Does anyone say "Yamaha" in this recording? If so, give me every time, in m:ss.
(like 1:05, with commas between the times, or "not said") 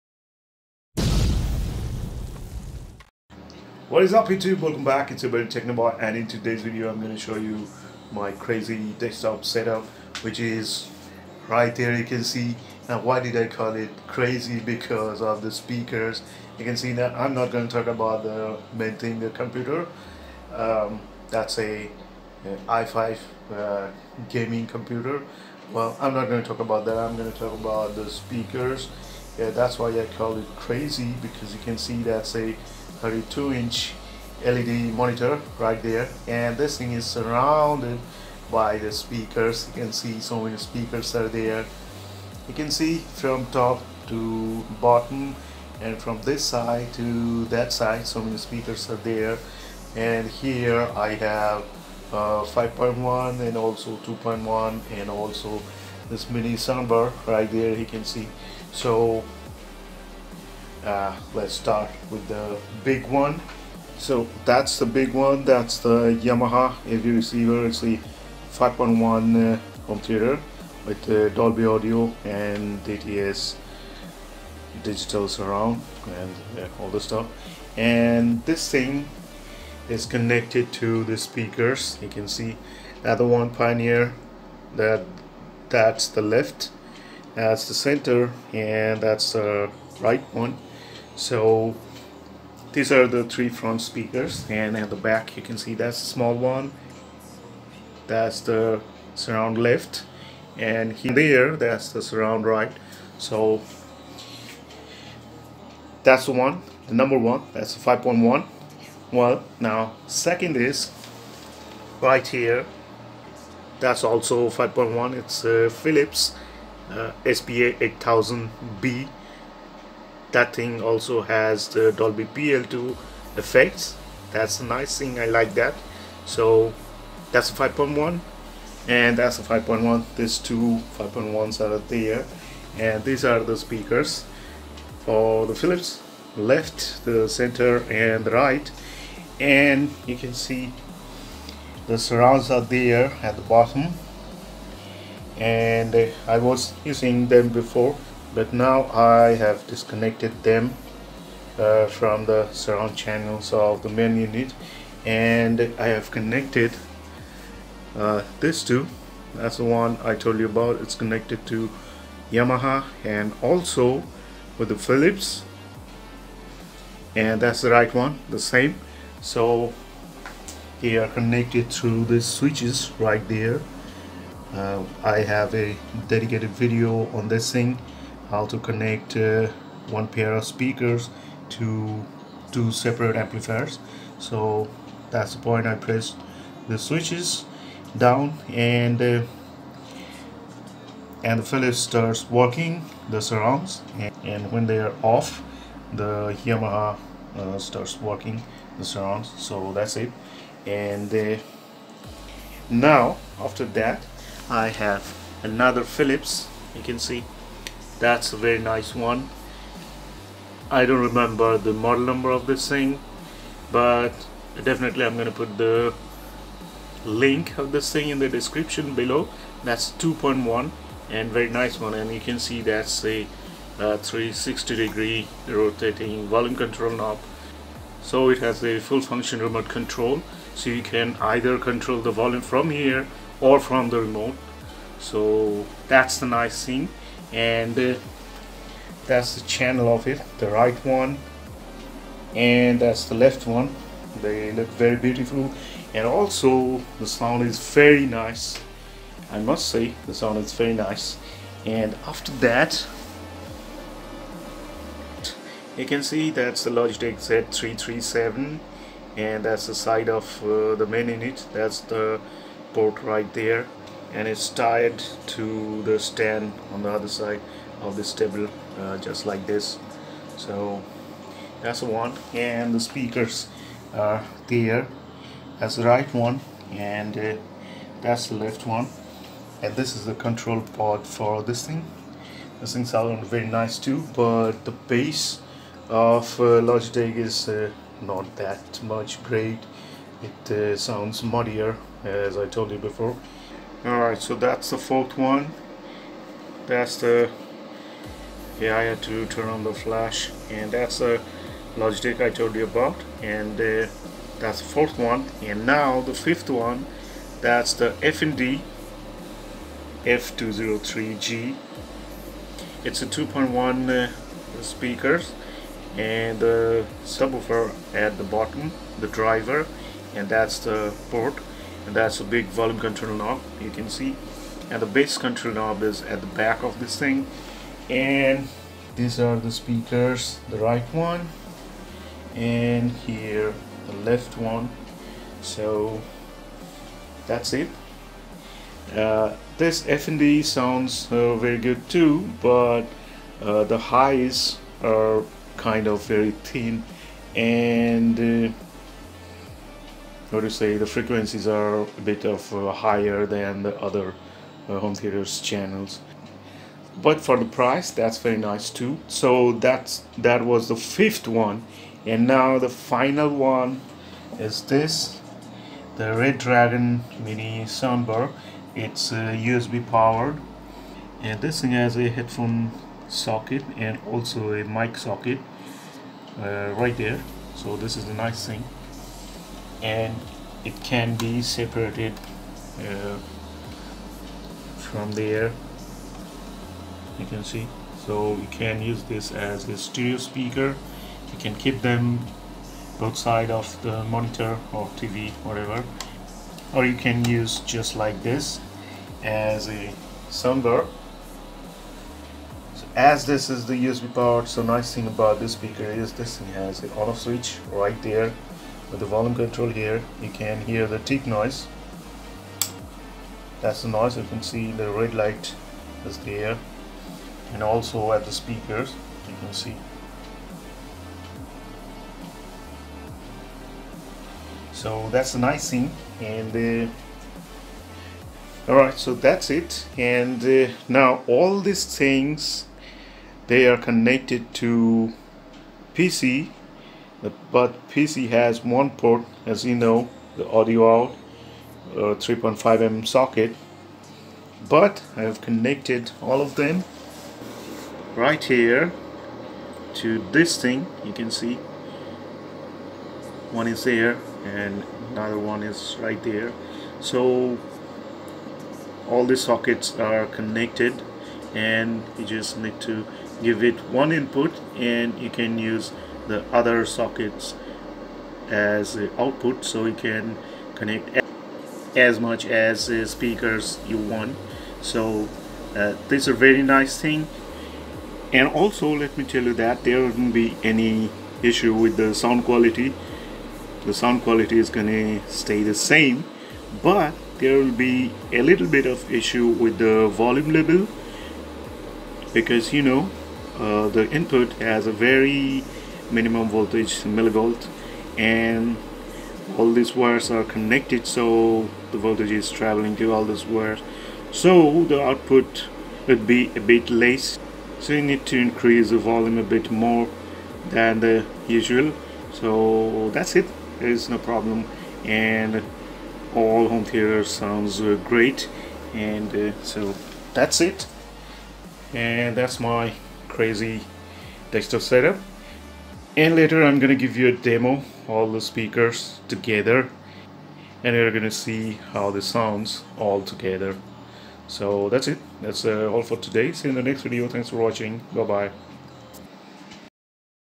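1:06, 2:42, 3:16.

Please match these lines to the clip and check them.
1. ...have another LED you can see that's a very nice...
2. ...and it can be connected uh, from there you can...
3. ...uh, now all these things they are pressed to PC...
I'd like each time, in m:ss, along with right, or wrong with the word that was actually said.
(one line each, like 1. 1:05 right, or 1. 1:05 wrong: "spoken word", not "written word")
1. 3:24 wrong: "Philips", not "LED"
2. 6:19 wrong: "separated", not "connected"
3. 7:10 wrong: "connected", not "pressed".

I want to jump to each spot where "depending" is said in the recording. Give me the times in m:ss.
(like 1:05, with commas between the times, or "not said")
not said.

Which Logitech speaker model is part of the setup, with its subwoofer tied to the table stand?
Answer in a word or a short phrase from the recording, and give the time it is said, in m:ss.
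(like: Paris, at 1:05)
Z337, at 4:17.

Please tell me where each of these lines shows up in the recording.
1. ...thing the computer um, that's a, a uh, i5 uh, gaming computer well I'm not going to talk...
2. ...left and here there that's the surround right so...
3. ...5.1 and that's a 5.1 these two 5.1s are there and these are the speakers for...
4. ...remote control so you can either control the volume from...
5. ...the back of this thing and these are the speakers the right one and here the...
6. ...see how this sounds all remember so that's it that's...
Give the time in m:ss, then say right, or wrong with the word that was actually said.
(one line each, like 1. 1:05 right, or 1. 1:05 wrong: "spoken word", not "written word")
1. 0:18 right
2. 1:39 right
3. 2:07 right
4. 3:49 right
5. 5:26 right
6. 8:51 wrong: "together", not "remember".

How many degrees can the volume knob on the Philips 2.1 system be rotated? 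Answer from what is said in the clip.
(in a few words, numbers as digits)
360.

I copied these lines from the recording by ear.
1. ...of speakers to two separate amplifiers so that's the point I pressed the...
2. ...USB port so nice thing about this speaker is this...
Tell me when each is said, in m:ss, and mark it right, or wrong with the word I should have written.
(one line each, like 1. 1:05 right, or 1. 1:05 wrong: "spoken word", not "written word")
1. 3:00 right
2. 6:43 right.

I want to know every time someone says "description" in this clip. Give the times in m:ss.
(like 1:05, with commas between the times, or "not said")
3:38.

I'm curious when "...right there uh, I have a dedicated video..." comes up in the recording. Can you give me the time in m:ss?
2:52.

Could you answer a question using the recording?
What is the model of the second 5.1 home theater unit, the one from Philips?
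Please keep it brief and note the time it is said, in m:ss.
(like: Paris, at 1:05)
SPA 8000B, at 1:57.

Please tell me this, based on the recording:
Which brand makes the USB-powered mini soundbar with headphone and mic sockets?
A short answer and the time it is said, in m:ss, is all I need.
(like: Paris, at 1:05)
Redragon, at 6:06.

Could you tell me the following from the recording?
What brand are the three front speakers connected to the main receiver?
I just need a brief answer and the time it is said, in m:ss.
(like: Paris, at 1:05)
Pioneer, at 1:23.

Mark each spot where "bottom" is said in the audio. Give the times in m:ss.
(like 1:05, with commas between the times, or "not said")
0:44, 2:23, 5:18.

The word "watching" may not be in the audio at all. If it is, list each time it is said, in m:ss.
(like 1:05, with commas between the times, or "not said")
8:57.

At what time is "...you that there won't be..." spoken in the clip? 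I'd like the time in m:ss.
7:59.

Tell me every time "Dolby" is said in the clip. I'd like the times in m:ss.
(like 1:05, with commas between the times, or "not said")
1:11, 2:01.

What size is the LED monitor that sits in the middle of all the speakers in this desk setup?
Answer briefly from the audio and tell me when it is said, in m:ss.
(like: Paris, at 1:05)
32 inch, at 0:33.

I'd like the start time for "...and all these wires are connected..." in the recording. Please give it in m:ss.
8:18.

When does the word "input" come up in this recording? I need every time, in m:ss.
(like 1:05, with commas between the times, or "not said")
7:44, 8:14.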